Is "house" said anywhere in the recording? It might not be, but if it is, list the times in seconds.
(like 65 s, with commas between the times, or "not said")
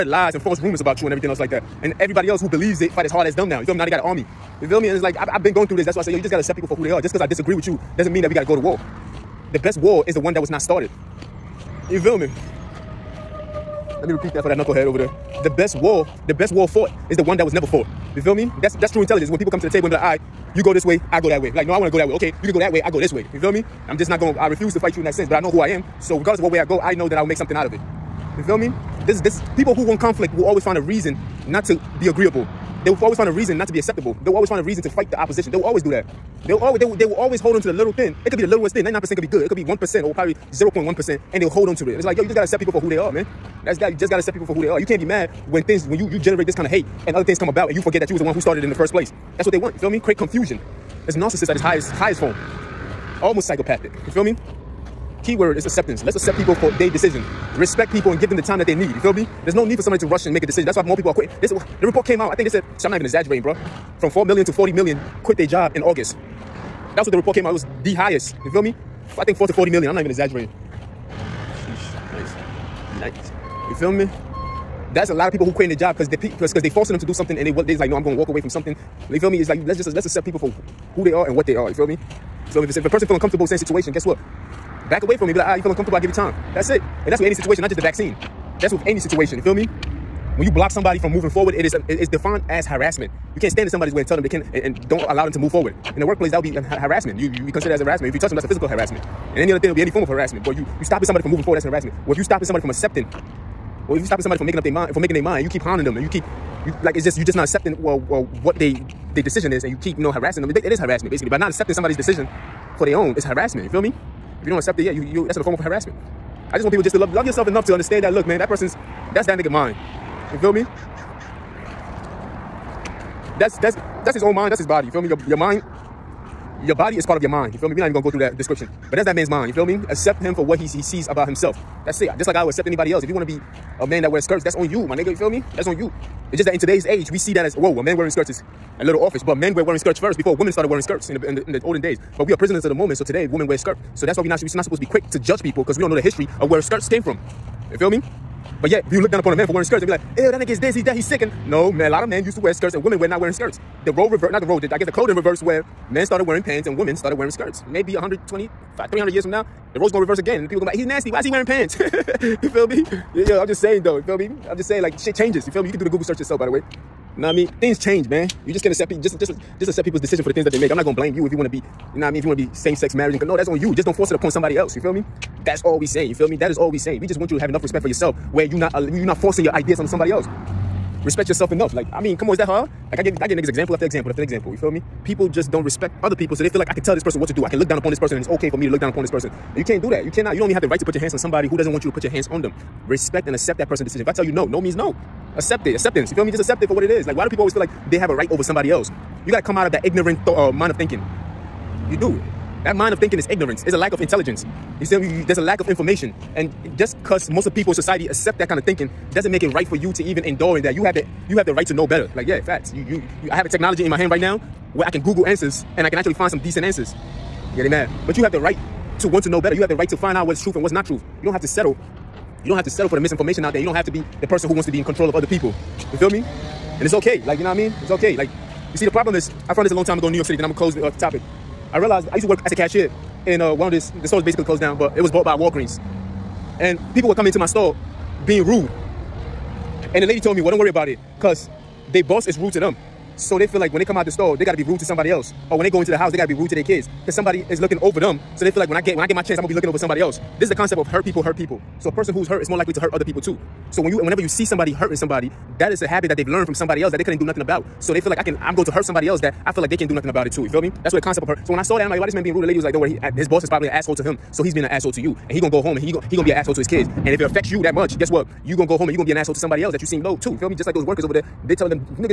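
245 s.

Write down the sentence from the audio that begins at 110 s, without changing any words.
It, it is harassment basically, by not accepting somebody's decision for their own it's harassment.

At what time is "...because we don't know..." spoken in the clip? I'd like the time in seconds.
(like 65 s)
145 s.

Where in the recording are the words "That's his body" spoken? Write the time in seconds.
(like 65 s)
124 s.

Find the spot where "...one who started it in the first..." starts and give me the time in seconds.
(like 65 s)
48 s.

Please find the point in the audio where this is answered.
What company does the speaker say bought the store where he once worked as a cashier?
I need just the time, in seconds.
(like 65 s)
235 s.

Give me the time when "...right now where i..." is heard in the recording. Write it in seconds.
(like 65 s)
214 s.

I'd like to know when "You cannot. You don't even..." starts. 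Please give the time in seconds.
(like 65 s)
190 s.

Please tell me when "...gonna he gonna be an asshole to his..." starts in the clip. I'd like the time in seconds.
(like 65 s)
265 s.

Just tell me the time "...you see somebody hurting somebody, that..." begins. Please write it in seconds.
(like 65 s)
254 s.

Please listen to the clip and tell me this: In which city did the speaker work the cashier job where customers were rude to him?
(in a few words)
New York City.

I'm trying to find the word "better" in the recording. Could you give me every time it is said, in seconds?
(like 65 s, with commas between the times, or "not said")
211 s, 219 s.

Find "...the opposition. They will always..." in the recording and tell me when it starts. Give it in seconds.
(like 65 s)
35 s.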